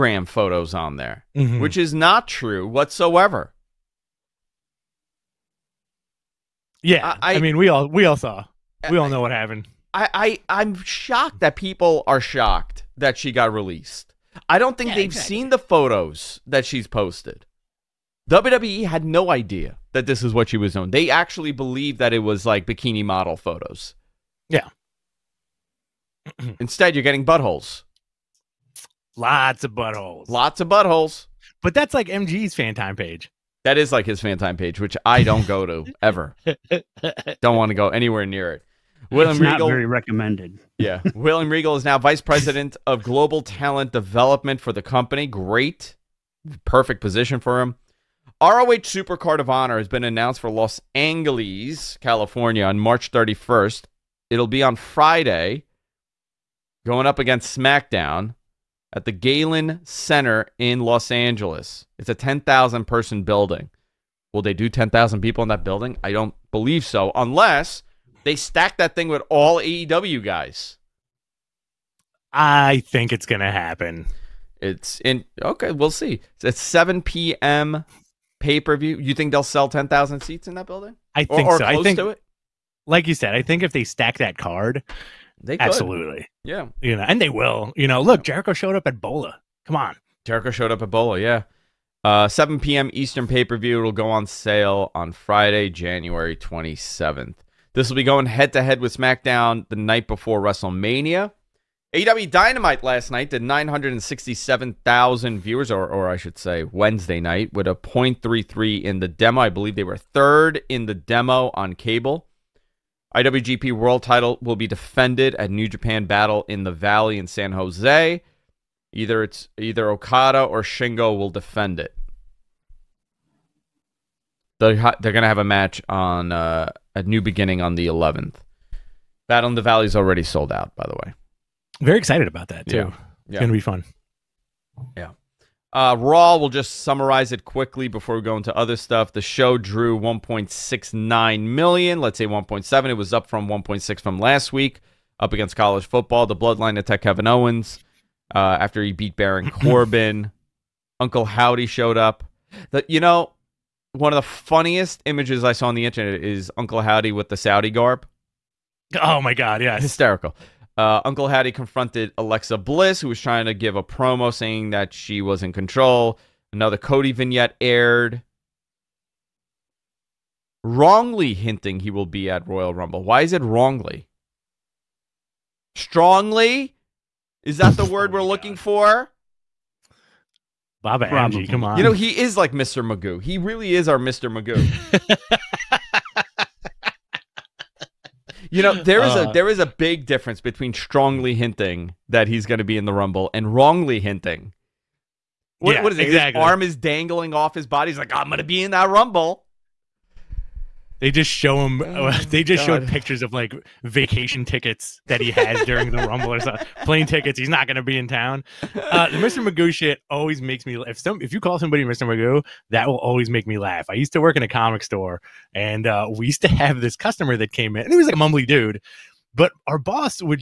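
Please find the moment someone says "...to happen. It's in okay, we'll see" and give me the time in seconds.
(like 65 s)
73 s.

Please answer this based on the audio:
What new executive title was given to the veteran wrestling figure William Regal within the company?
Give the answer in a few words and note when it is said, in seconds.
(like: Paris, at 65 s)
Vice president of global talent development, at 41 s.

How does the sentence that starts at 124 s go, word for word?
They're, they're going to have a match on uh, a new beginning on the 11th.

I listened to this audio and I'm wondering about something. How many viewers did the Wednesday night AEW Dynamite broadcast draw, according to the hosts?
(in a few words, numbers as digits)
967,000.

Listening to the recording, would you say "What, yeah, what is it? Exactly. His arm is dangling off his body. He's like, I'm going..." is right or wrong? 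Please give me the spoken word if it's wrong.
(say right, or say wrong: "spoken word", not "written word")
right.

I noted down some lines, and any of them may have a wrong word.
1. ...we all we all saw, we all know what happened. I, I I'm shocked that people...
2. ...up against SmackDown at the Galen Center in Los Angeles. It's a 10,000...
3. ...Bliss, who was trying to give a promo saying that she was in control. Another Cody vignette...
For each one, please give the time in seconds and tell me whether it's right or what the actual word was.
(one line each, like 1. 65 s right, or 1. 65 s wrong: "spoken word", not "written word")
1. 7 s right
2. 57 s right
3. 162 s right.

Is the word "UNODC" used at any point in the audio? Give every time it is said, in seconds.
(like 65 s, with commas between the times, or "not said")
not said.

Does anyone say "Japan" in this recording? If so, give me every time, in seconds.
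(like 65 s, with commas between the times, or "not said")
115 s.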